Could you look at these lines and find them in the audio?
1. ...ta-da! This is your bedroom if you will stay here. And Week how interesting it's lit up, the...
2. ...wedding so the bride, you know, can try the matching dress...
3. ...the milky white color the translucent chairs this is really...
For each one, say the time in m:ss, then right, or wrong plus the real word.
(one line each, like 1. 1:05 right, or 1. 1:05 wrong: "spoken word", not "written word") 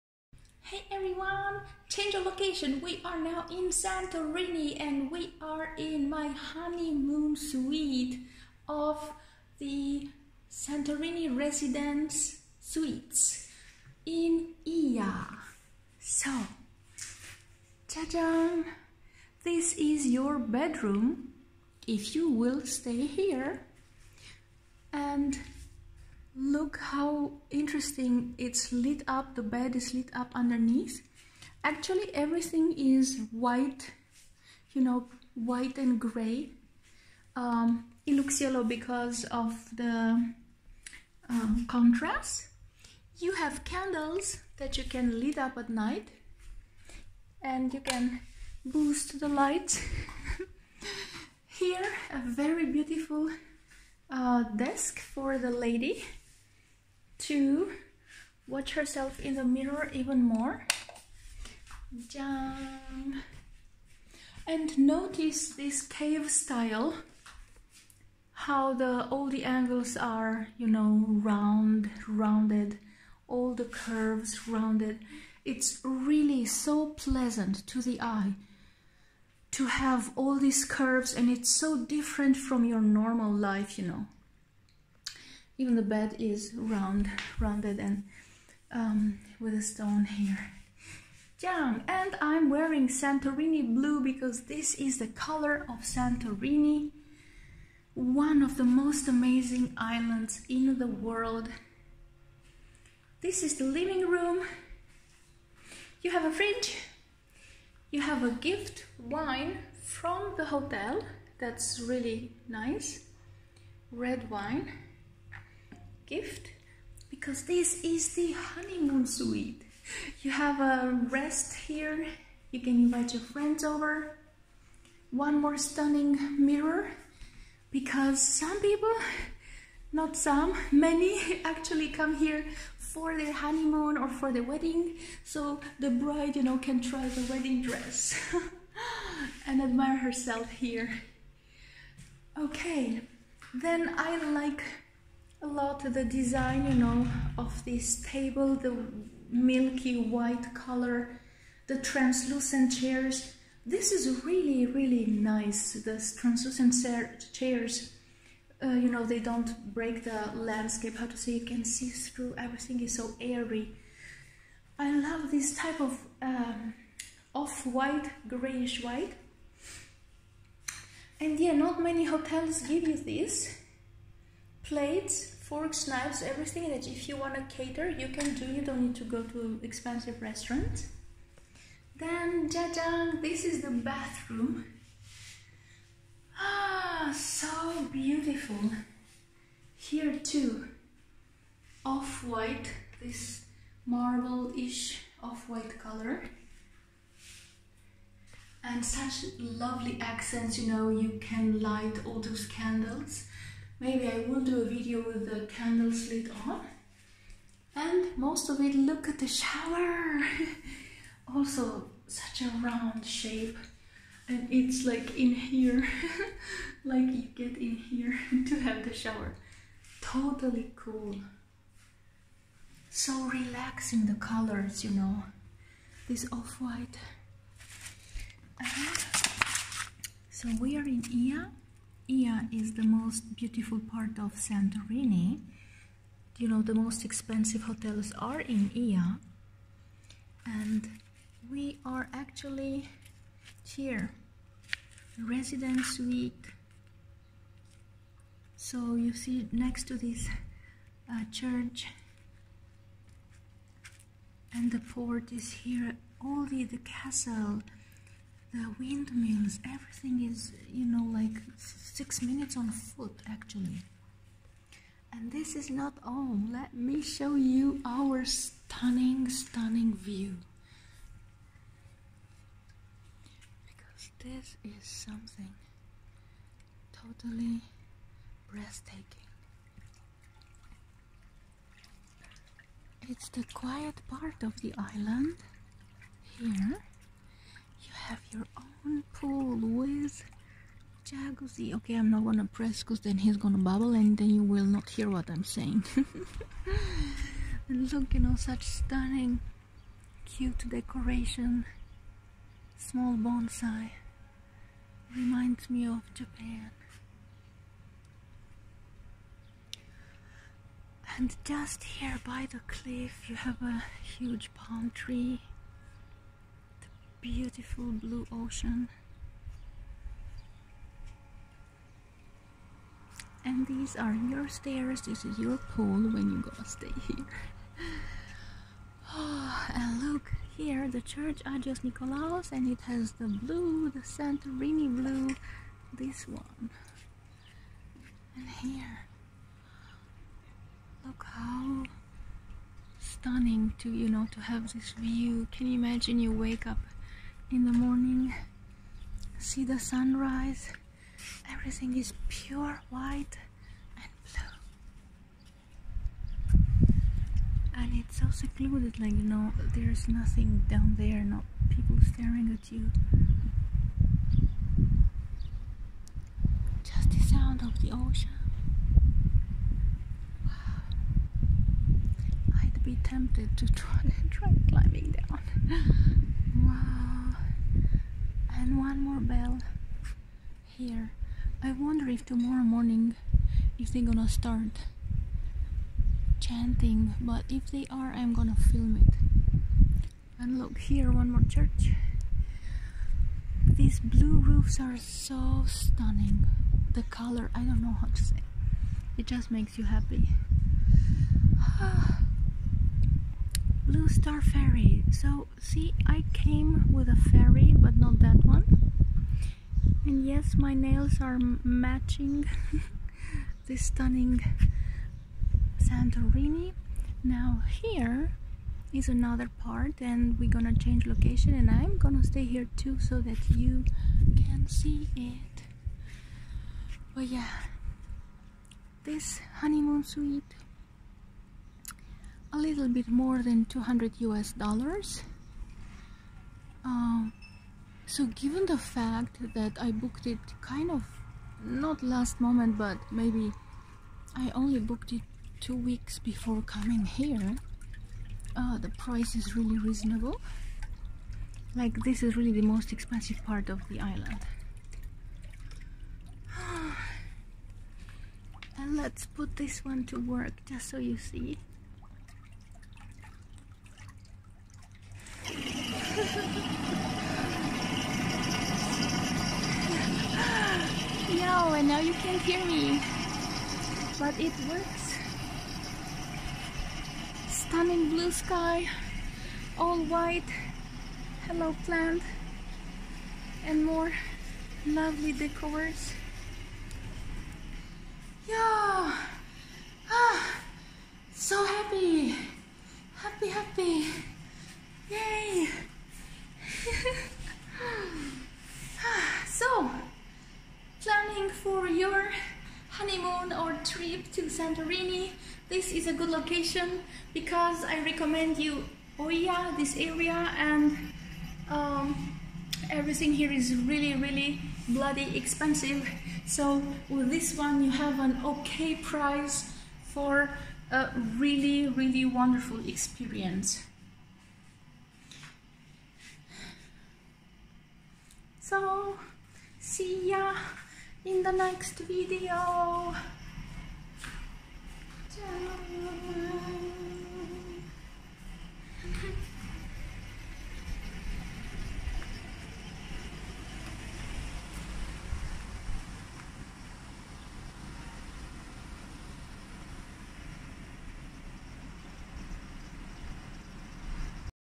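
1. 0:17 wrong: "Look", not "Week"
2. 2:14 wrong: "wedding", not "matching"
3. 2:28 right.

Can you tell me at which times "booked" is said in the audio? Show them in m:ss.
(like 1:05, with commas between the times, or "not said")
7:19, 7:24.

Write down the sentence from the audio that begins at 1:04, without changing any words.
And notice this cave style, how the all the angles are, you know, round, rounded, all the curves rounded.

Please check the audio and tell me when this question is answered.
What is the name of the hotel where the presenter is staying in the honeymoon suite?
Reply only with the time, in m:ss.
0:10.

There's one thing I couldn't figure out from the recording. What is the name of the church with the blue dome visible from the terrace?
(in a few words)
Agios Nikolaos.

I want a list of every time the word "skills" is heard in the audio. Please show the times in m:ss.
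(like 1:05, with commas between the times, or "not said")
not said.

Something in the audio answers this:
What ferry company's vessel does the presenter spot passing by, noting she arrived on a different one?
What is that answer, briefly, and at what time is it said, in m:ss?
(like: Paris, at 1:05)
Blue Star Ferry, at 6:43.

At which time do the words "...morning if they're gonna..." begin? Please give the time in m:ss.
6:22.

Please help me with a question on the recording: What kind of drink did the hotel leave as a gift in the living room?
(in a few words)
Red wine.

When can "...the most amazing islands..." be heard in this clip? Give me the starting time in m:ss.
1:38.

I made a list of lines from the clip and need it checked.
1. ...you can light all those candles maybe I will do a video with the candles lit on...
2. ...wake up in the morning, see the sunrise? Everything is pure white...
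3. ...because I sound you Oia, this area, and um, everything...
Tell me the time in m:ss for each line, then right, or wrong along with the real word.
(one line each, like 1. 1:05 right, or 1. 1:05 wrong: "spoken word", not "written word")
1. 3:20 right
2. 5:46 right
3. 8:27 wrong: "recommend", not "sound".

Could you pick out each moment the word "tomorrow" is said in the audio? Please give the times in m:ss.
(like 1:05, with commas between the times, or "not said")
6:22.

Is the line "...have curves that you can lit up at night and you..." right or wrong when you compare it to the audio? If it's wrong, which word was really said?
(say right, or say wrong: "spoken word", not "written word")
wrong: "candles", not "curves".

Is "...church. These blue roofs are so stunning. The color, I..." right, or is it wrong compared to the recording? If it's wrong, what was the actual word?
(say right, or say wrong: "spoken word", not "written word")
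right.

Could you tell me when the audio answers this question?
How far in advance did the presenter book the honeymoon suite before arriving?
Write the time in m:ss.
7:25.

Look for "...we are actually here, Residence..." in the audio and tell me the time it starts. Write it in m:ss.
4:01.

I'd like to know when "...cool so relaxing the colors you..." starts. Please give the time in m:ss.
3:40.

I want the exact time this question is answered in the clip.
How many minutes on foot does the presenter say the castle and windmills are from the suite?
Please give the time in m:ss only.
4:22.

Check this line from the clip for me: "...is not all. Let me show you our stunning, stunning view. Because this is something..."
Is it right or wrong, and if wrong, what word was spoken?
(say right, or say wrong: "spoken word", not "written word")
right.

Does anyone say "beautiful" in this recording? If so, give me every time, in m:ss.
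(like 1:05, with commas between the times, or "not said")
0:52, 3:07, 3:53, 5:17.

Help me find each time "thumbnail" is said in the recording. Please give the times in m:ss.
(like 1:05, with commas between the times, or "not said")
not said.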